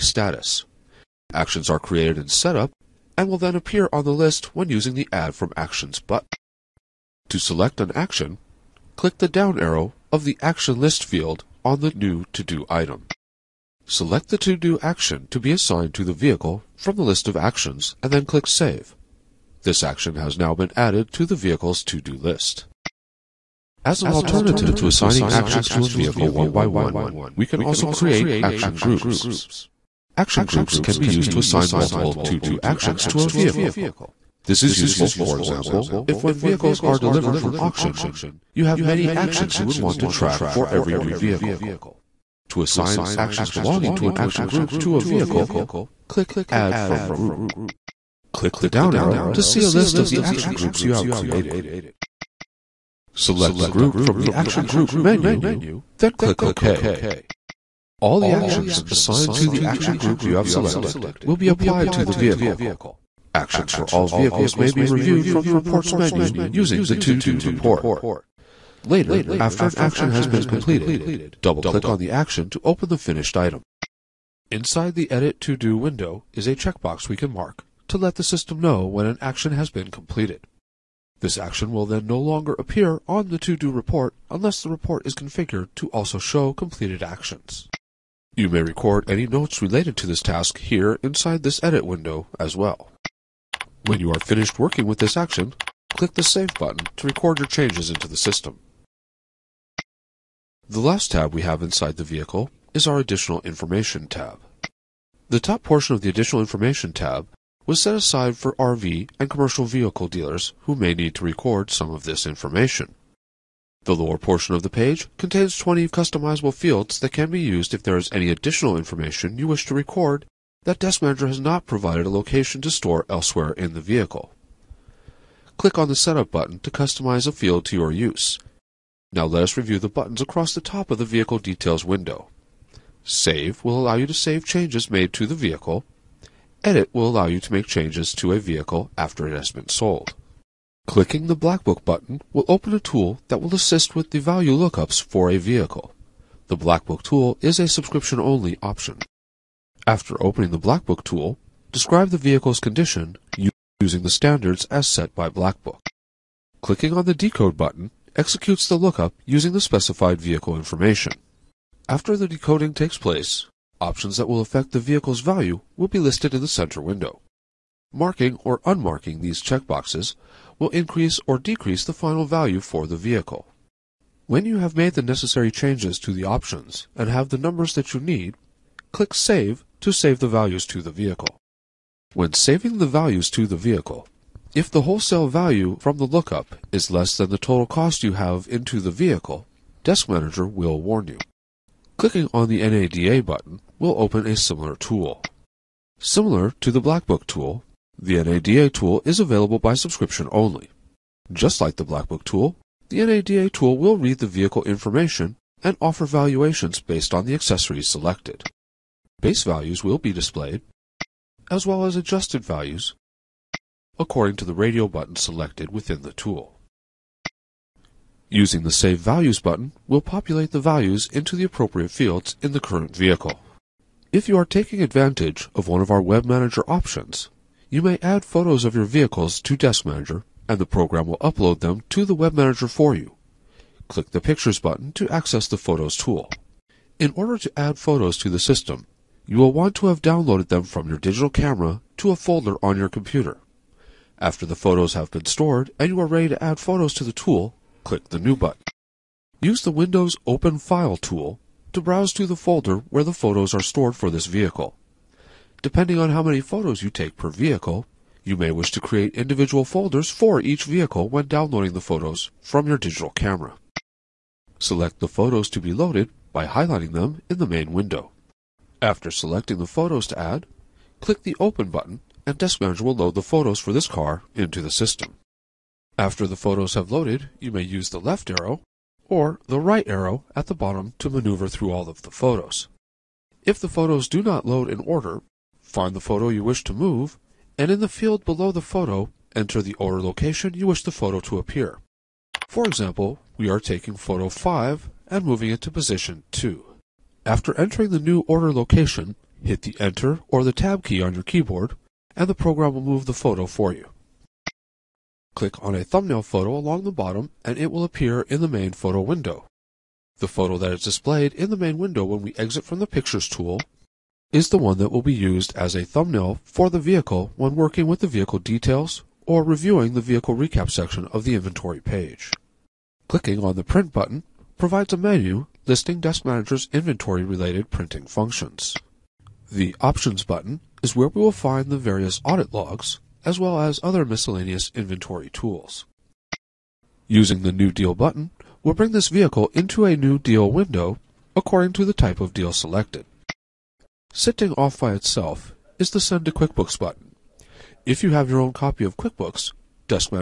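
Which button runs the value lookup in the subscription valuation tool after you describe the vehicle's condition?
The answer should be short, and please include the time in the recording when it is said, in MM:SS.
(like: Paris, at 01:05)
Decode, at 02:37.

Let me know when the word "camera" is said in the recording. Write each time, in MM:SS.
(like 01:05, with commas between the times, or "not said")
04:01, 04:23.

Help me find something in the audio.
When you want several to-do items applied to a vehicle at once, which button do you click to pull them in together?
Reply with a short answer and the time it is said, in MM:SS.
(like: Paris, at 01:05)
Add from Group, at 00:46.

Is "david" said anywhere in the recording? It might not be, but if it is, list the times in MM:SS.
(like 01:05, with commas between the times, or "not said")
not said.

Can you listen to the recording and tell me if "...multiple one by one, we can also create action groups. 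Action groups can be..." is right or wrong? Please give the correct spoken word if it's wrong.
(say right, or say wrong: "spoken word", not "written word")
wrong: "vehicle", not "multiple".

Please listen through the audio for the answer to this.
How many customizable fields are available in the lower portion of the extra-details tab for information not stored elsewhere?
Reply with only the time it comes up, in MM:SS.
01:55.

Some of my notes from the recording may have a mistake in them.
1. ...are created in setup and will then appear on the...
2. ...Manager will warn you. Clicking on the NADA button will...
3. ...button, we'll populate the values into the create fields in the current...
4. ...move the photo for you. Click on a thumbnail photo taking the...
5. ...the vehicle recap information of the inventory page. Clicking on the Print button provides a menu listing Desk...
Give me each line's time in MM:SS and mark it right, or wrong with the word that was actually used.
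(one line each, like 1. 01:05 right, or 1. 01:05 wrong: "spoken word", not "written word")
1. 00:01 right
2. 03:10 right
3. 03:39 wrong: "appropriate", not "create"
4. 05:02 wrong: "along", not "taking"
5. 05:19 wrong: "section", not "information".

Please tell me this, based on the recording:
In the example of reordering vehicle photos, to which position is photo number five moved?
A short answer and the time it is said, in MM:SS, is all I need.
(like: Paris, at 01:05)
2, at 04:55.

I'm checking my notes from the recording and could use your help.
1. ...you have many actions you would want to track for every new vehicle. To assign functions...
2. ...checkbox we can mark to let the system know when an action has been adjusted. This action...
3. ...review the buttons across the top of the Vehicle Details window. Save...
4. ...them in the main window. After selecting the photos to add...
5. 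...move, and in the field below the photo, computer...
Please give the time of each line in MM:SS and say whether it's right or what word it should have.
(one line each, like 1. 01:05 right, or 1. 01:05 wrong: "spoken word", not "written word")
1. 00:38 wrong: "actions", not "functions"
2. 01:16 wrong: "completed", not "adjusted"
3. 02:09 right
4. 04:26 right
5. 04:46 wrong: "enter", not "computer".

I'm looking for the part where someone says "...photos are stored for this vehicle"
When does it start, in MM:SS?
04:13.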